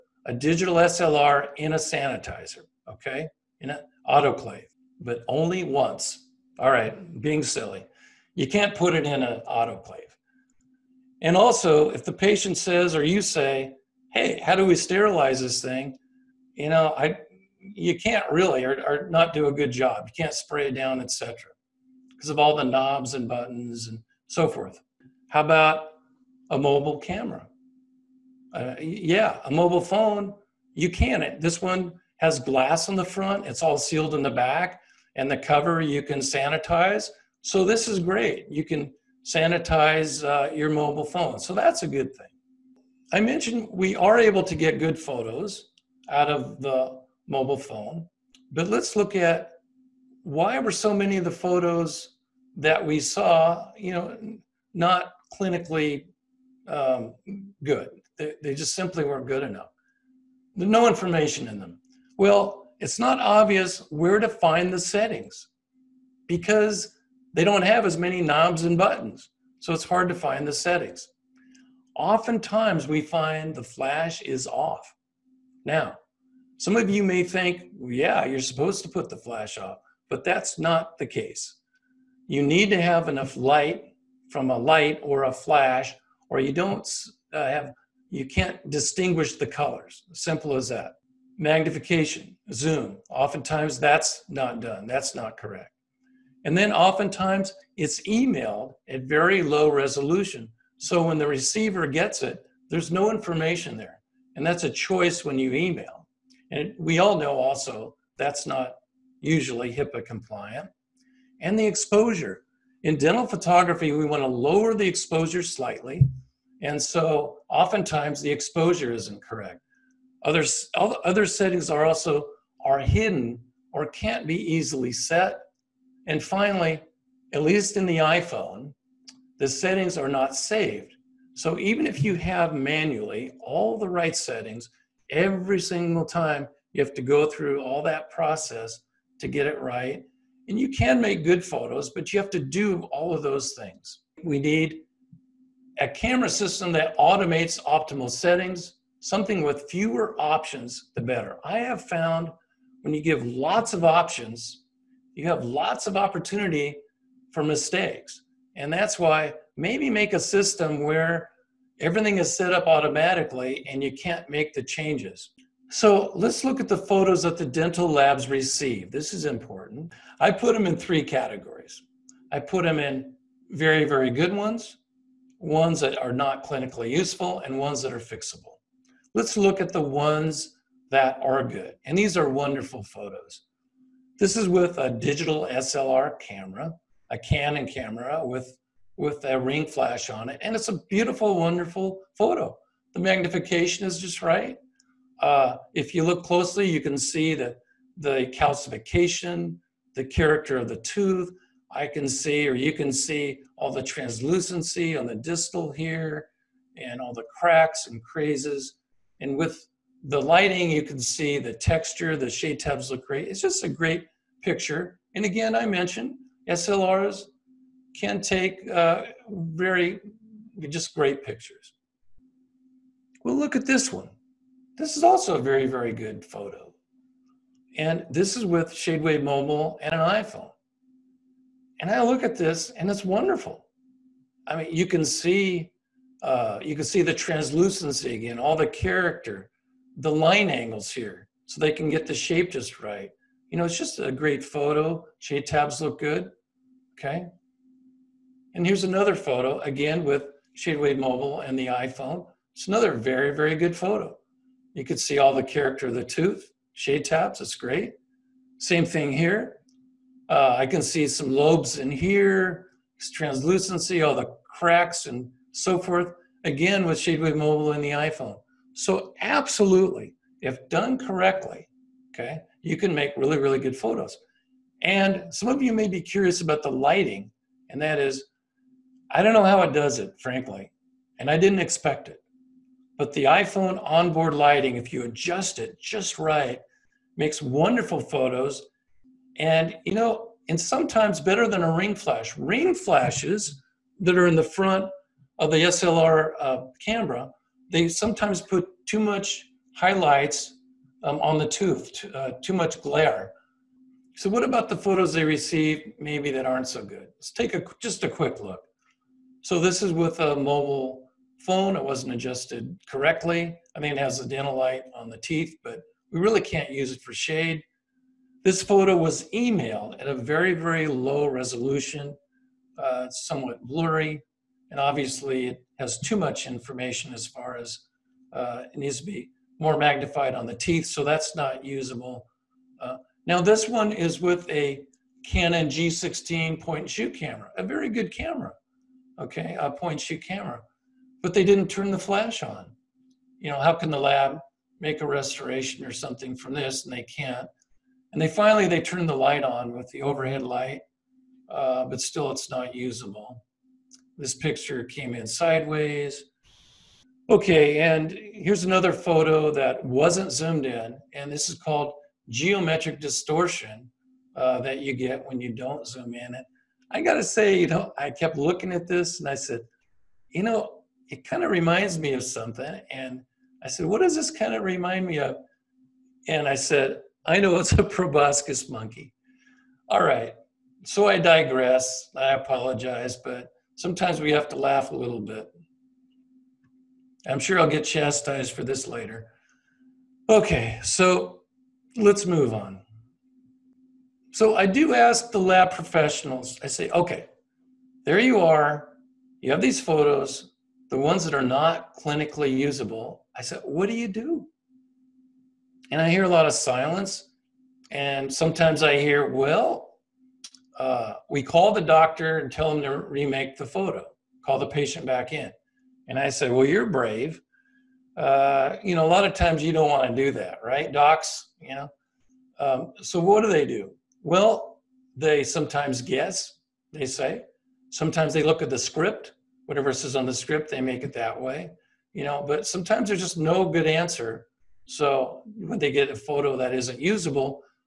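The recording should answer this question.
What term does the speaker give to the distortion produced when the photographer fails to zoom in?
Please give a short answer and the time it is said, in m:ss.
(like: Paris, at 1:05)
geometric distortion, at 6:02.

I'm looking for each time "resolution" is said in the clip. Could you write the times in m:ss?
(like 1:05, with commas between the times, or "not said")
1:39, 5:21.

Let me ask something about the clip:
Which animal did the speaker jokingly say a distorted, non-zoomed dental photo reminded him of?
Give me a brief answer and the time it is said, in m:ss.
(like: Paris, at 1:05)
proboscis monkey, at 6:17.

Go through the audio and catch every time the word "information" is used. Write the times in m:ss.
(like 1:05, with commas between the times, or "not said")
1:00, 1:43, 5:26.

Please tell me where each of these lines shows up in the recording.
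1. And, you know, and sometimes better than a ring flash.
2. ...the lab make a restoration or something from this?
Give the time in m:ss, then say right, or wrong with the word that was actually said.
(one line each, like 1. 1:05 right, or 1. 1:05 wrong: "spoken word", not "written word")
1. 4:49 right
2. 5:43 right.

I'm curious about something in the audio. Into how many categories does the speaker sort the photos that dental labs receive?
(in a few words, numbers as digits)
3.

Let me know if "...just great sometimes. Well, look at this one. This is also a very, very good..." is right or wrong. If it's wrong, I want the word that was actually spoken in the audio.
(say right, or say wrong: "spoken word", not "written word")
wrong: "pictures", not "sometimes".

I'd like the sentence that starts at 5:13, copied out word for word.
I mean, it has a dental light on the teeth, but we really can't use it for shade.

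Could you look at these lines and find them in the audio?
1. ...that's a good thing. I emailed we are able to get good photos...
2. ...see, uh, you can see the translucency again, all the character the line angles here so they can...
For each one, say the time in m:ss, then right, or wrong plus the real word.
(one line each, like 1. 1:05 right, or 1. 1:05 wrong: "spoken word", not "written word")
1. 0:41 wrong: "mentioned", not "emailed"
2. 3:55 right.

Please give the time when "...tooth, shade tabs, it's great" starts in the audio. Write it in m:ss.
4:16.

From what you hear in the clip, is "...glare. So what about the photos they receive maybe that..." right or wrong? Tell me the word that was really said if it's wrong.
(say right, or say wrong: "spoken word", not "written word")
right.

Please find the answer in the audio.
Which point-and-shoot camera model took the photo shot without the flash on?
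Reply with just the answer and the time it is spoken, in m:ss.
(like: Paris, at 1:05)
Canon G16, at 5:35.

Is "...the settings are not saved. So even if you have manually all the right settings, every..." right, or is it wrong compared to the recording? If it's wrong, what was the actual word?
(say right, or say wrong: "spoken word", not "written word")
right.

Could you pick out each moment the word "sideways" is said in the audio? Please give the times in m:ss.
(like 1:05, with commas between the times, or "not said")
5:55.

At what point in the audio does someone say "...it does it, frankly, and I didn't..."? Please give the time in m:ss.
4:39.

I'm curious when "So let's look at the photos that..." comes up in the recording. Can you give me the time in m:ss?
2:45.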